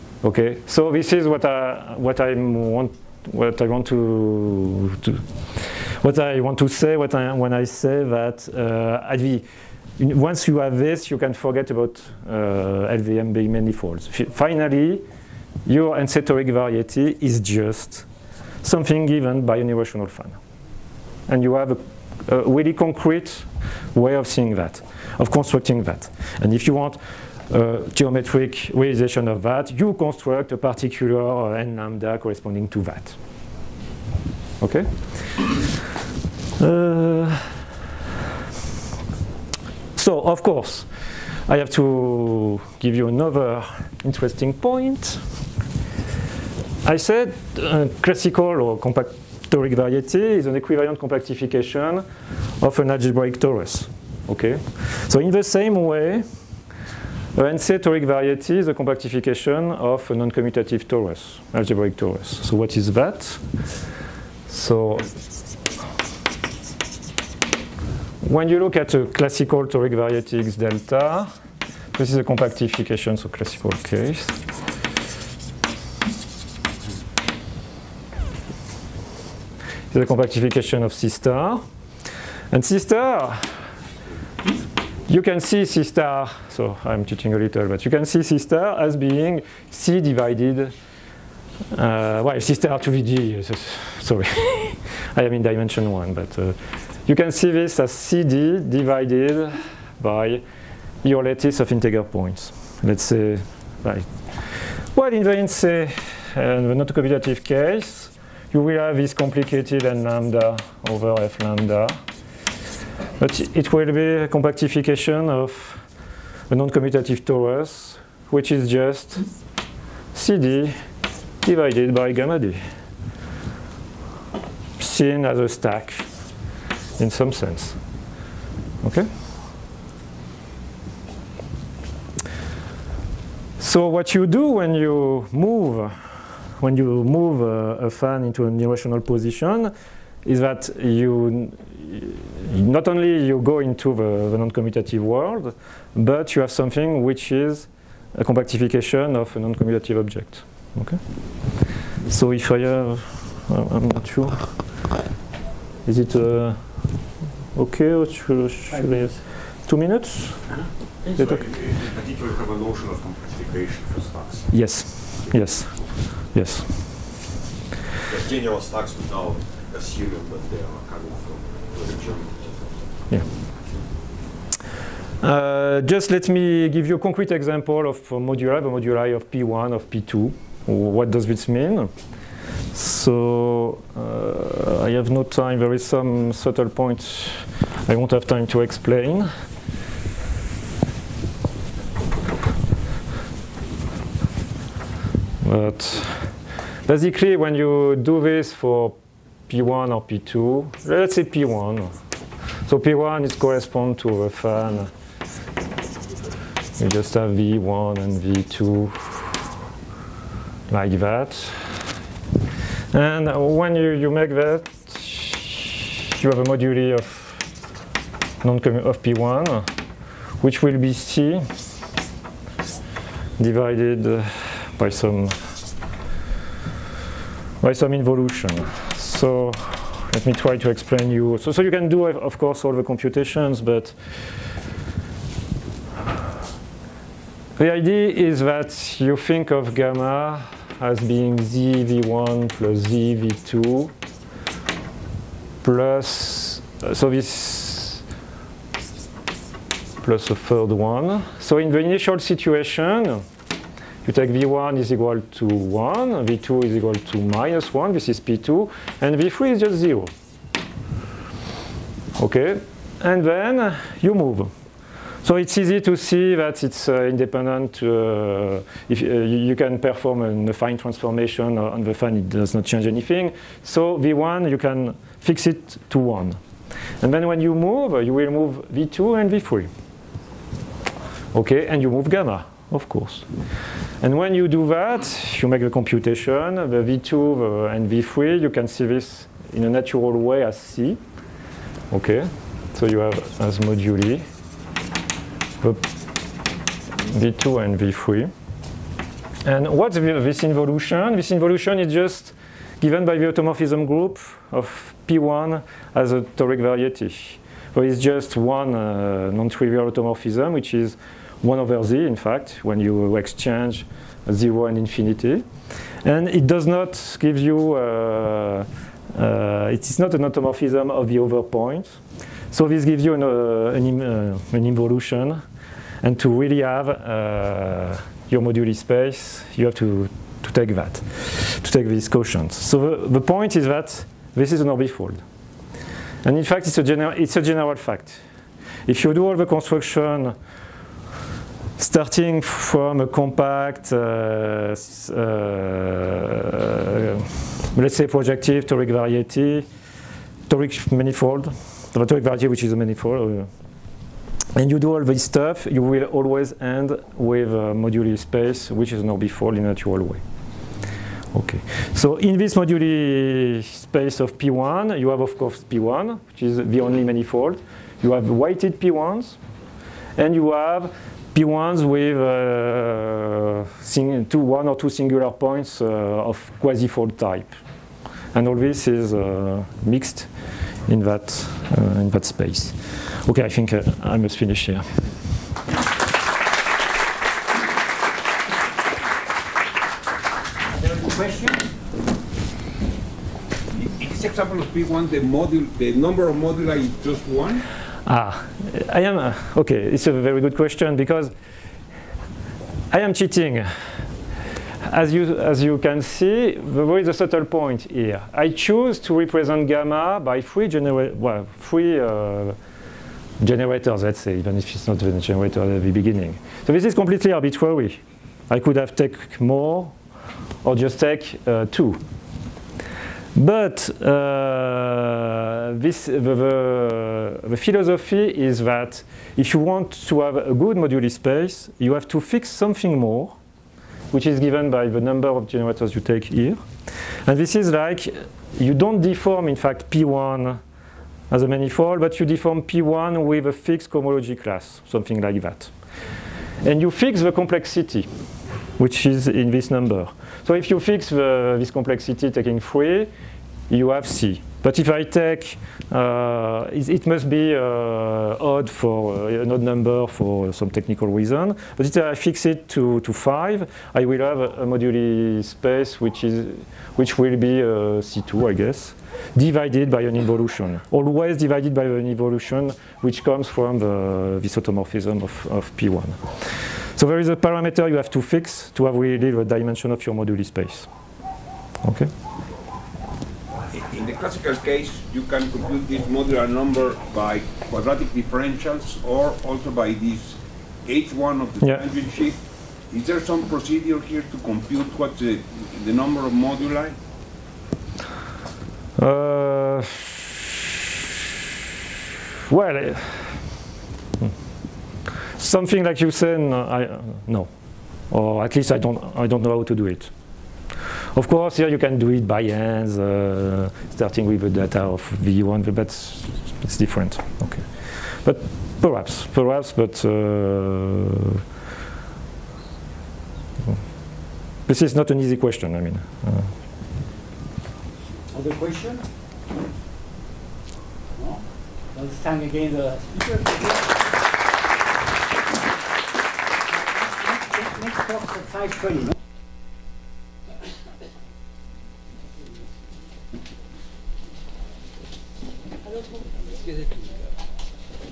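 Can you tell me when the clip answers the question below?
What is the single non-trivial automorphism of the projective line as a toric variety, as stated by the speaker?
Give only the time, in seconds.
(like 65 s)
311 s.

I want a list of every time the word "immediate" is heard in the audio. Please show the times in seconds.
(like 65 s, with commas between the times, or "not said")
not said.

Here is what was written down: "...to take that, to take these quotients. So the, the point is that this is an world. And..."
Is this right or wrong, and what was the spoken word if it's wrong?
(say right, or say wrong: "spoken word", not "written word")
wrong: "orbifold", not "world".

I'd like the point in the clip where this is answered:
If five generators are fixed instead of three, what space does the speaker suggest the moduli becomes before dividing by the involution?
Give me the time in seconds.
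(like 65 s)
468 s.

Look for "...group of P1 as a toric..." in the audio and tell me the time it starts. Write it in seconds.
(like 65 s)
303 s.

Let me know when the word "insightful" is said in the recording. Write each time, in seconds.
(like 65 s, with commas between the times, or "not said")
not said.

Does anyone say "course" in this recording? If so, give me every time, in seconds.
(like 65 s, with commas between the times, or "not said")
40 s, 232 s, 282 s, 365 s, 511 s.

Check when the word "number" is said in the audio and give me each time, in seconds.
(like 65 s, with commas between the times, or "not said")
395 s, 434 s, 449 s, 459 s, 486 s, 495 s.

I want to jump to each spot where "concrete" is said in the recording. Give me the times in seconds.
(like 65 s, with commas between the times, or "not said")
22 s, 176 s.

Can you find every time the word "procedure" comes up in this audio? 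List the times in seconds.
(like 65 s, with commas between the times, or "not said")
493 s.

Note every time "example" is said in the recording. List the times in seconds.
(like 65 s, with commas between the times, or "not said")
177 s, 394 s.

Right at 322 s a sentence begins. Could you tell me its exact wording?
So this gives you an, uh, an, uh, an, involution.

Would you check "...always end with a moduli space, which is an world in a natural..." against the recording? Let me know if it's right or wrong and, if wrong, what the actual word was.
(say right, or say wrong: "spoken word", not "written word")
wrong: "orbifold", not "world".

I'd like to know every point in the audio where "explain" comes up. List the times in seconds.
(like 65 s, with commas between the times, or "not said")
188 s, 230 s.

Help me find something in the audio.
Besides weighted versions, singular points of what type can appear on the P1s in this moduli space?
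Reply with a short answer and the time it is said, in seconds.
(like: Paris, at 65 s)
quasi-fold type, at 376 s.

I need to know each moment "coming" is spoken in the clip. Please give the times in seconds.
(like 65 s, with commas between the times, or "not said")
170 s.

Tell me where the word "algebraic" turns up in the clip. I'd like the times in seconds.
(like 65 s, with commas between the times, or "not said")
52 s, 61 s.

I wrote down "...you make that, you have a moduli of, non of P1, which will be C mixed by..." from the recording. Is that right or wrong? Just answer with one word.
wrong.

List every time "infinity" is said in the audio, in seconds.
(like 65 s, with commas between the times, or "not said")
314 s.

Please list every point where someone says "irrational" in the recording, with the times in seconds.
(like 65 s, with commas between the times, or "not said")
19 s, 138 s.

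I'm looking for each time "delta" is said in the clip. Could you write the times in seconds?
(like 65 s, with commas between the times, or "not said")
70 s.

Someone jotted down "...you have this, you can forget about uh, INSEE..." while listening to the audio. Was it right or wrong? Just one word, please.
wrong.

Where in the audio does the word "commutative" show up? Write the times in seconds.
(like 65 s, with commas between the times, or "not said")
60 s, 106 s, 116 s, 144 s, 149 s.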